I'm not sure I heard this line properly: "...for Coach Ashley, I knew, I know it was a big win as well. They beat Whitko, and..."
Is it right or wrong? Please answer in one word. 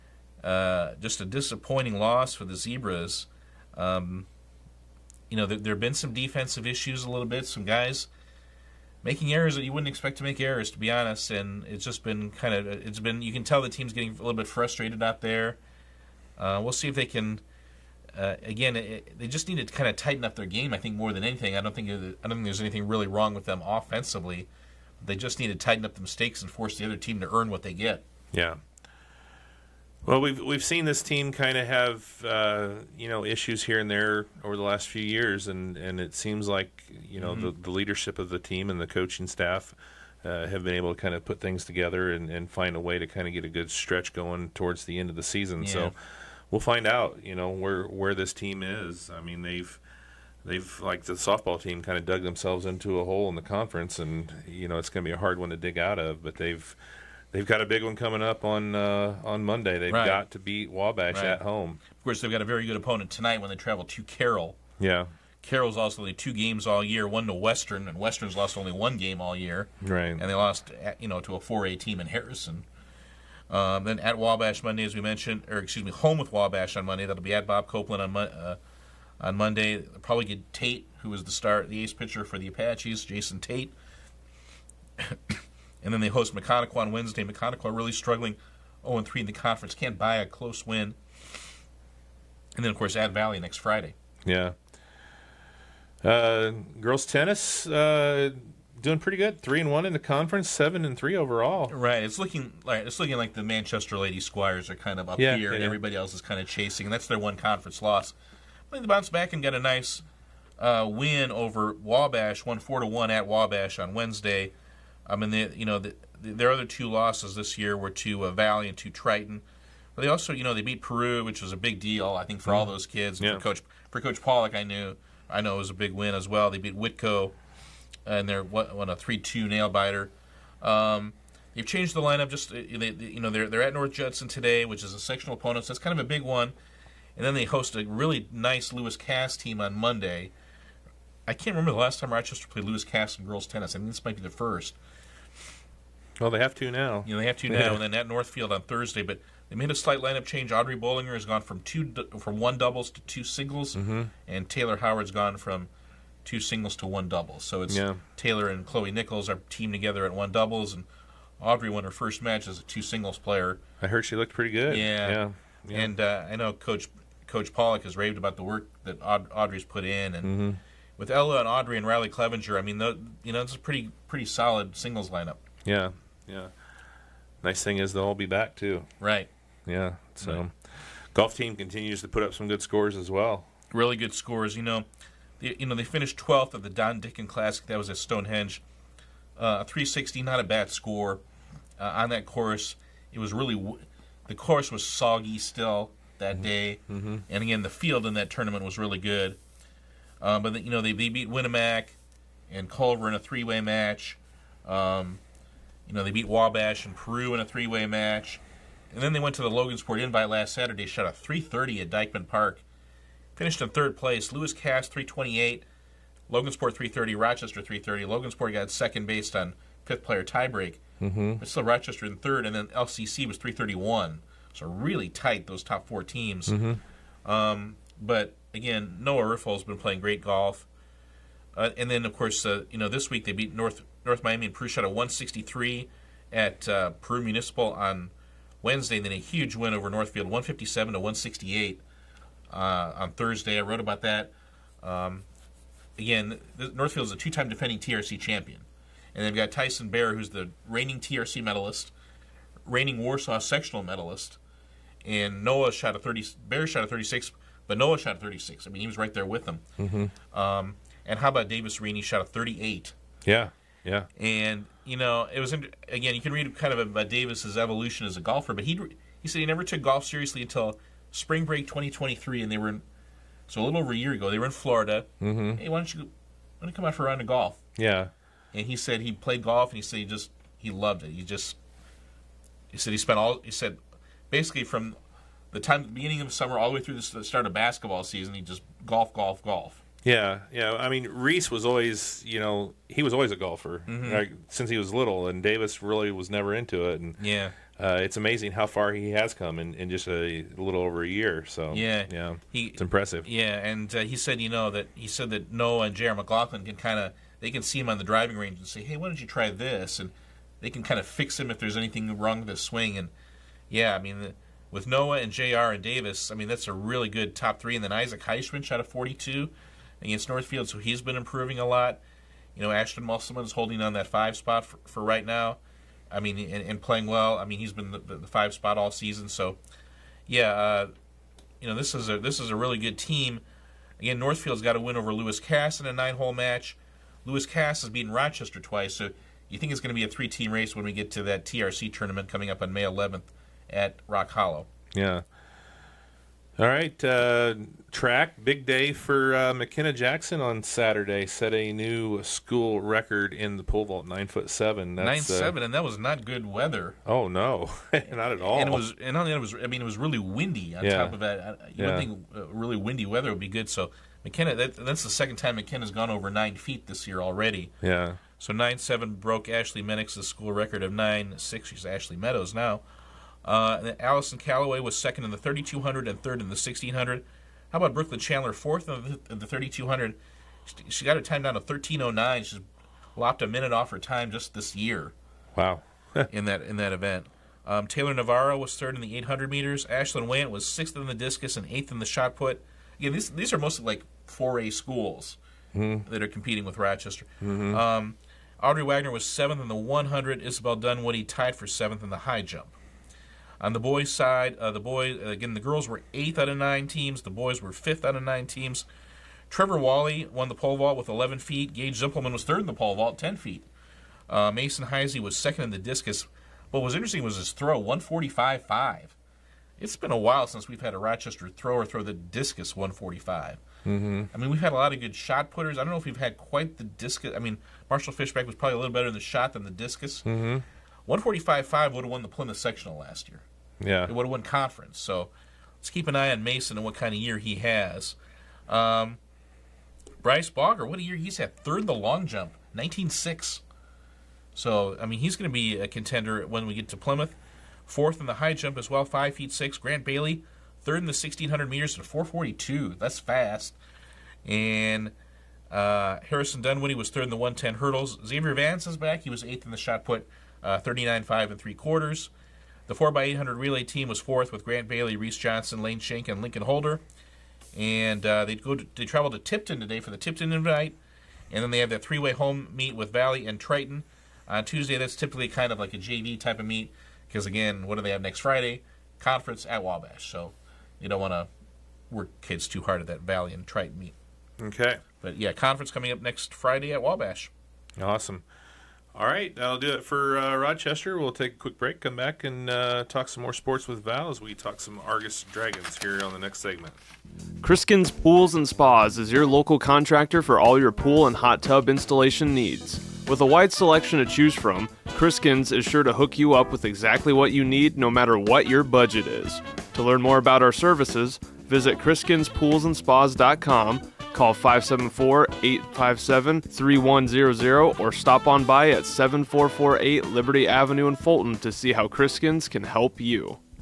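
wrong.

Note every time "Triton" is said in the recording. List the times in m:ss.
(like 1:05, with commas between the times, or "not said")
1:58, 7:53, 8:03.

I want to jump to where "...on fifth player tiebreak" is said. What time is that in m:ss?
3:39.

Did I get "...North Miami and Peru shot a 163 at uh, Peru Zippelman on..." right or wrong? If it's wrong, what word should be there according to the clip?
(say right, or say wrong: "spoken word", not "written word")
wrong: "Municipal", not "Zippelman".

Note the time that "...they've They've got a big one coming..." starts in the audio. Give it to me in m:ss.
0:56.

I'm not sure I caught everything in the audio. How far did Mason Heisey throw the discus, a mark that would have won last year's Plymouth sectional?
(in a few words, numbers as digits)
145.5.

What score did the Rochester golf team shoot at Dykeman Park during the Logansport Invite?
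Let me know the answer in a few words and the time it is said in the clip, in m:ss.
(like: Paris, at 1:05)
330, at 3:30.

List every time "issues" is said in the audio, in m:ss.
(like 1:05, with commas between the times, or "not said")
0:06, 0:33.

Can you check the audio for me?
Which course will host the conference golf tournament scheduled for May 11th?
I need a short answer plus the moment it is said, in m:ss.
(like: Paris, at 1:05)
Rock Hollow, at 5:44.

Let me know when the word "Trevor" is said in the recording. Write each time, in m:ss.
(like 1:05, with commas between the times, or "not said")
6:49.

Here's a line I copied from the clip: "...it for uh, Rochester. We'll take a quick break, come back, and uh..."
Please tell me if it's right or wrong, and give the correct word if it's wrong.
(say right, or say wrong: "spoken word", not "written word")
right.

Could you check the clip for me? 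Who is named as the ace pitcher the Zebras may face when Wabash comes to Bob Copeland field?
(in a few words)
Jason Tate.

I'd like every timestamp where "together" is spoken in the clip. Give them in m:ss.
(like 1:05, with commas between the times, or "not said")
0:41, 2:39.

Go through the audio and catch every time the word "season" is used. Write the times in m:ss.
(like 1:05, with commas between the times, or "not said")
0:45, 4:48, 5:28.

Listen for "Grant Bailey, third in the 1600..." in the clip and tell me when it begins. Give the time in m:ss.
7:29.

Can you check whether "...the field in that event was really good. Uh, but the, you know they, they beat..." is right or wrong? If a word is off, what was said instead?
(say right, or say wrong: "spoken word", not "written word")
wrong: "tournament", not "event".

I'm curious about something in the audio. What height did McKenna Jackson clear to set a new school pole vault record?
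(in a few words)
9 feet 7.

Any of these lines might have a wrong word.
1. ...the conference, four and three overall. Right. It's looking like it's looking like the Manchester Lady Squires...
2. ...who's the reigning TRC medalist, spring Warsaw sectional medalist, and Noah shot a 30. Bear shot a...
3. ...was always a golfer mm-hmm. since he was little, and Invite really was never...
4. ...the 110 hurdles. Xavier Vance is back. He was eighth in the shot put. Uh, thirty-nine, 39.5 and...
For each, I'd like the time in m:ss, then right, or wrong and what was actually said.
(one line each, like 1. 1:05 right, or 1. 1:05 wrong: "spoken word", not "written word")
1. 1:39 wrong: "seven", not "four"
2. 4:10 wrong: "reigning", not "spring"
3. 4:53 wrong: "Davis", not "Invite"
4. 7:37 right.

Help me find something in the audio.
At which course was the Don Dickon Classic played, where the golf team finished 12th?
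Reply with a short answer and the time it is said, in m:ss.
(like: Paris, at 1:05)
Stonehenge, at 3:07.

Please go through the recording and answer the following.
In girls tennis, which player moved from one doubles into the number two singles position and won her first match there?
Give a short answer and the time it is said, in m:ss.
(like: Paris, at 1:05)
Audrey Bollinger, at 2:30.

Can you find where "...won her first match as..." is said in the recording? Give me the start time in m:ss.
2:41.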